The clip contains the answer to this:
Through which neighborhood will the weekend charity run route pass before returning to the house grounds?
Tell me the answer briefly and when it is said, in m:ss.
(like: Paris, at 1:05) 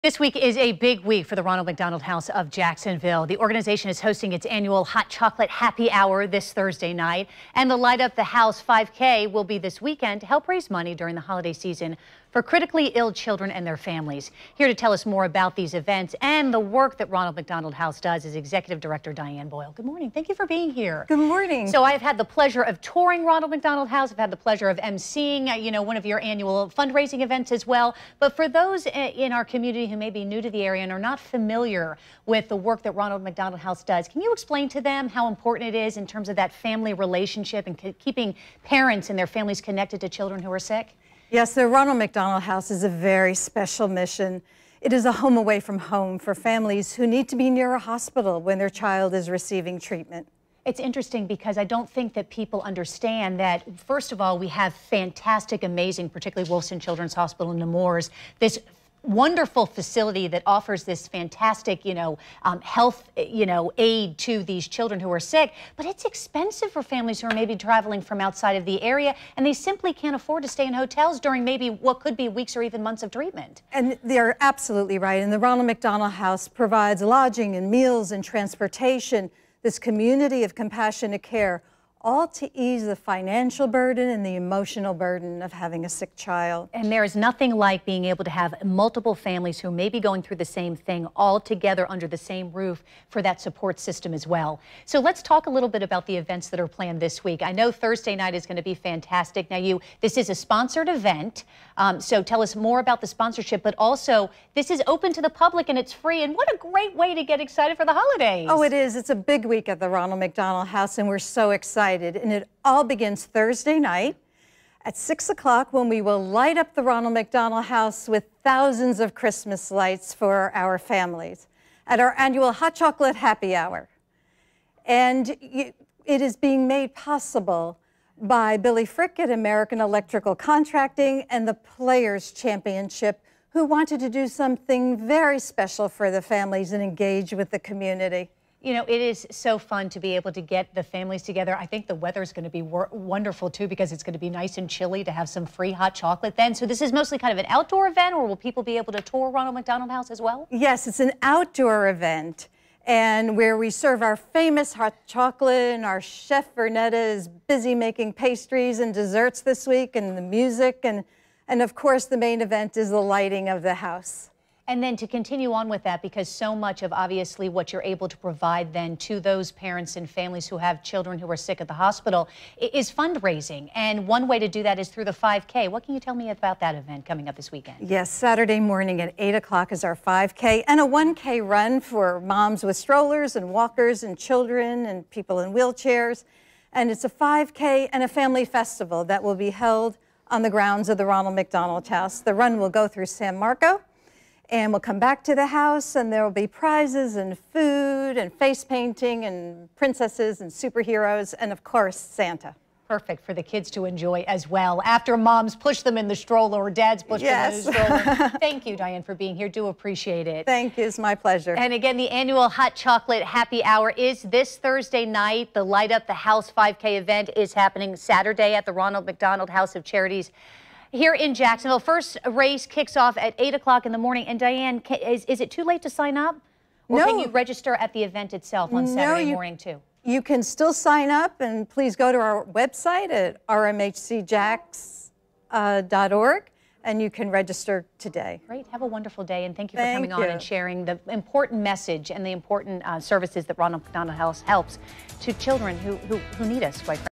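San Marco, at 3:13.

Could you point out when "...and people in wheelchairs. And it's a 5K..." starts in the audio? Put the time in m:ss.
3:04.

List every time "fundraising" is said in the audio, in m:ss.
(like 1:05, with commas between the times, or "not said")
0:26, 2:52.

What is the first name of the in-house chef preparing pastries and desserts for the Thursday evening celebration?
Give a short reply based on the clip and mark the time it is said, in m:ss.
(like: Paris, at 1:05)
Vernetta, at 2:36.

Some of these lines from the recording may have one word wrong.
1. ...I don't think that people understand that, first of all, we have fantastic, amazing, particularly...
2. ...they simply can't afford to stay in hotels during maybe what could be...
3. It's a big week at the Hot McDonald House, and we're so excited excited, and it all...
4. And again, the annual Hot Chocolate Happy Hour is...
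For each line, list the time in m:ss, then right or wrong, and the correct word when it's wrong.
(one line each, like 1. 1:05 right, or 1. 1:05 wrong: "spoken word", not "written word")
1. 0:51 right
2. 1:09 right
3. 1:48 wrong: "Ronald", not "Hot"
4. 3:31 right.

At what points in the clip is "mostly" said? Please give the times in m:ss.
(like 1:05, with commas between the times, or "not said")
2:26.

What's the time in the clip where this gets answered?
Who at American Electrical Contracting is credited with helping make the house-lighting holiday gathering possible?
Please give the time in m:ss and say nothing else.
2:08.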